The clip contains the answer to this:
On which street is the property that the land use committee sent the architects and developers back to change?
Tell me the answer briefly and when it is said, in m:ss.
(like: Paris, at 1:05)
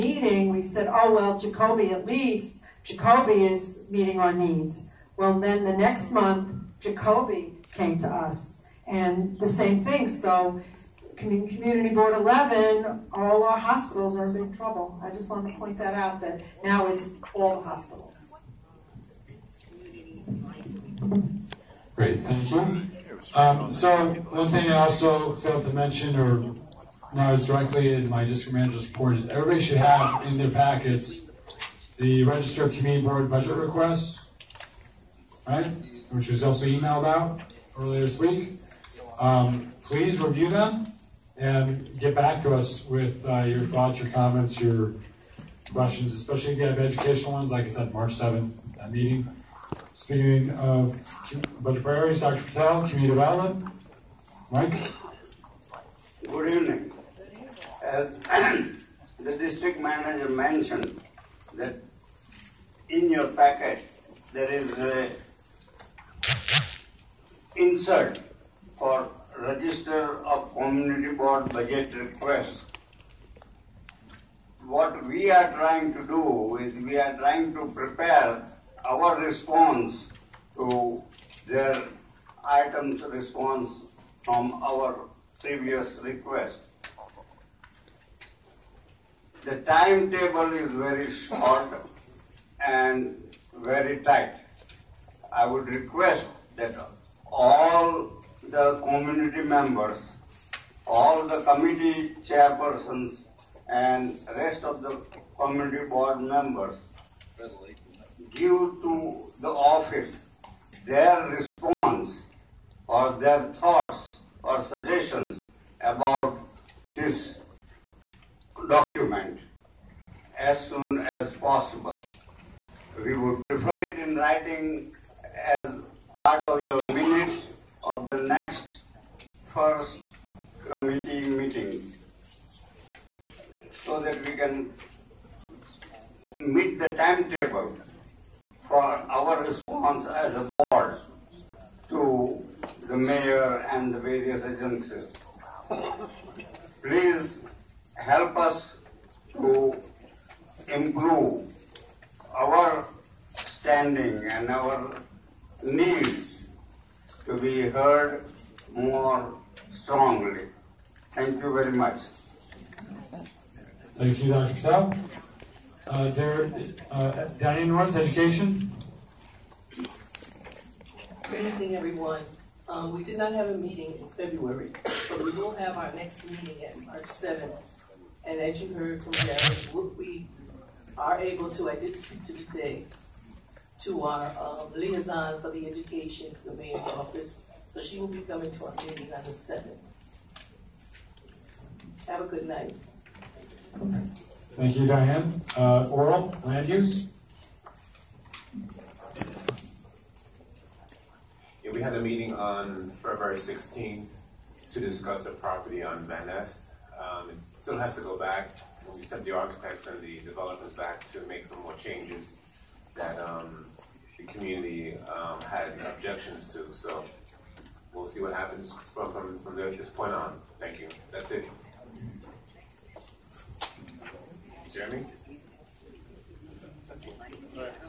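Van Nest, at 3:26.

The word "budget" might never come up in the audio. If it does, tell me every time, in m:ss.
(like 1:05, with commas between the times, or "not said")
0:33, 0:51, 1:11.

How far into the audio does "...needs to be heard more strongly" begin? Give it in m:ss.
2:35.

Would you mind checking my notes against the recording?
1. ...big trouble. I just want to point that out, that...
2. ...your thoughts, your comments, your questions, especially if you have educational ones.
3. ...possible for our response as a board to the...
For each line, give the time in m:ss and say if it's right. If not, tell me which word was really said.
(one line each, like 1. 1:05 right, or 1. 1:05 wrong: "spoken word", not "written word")
1. 0:14 right
2. 0:43 right
3. 2:16 wrong: "timetable", not "possible".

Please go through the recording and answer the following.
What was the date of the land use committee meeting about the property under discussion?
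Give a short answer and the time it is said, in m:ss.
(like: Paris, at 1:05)
February 16th, at 3:22.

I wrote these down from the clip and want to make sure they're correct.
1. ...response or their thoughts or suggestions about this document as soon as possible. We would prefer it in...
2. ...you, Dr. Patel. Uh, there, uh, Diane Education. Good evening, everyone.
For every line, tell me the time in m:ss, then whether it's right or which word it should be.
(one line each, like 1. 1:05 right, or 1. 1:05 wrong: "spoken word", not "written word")
1. 1:51 right
2. 2:44 right.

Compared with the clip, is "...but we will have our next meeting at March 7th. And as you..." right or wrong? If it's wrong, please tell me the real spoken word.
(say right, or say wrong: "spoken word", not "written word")
right.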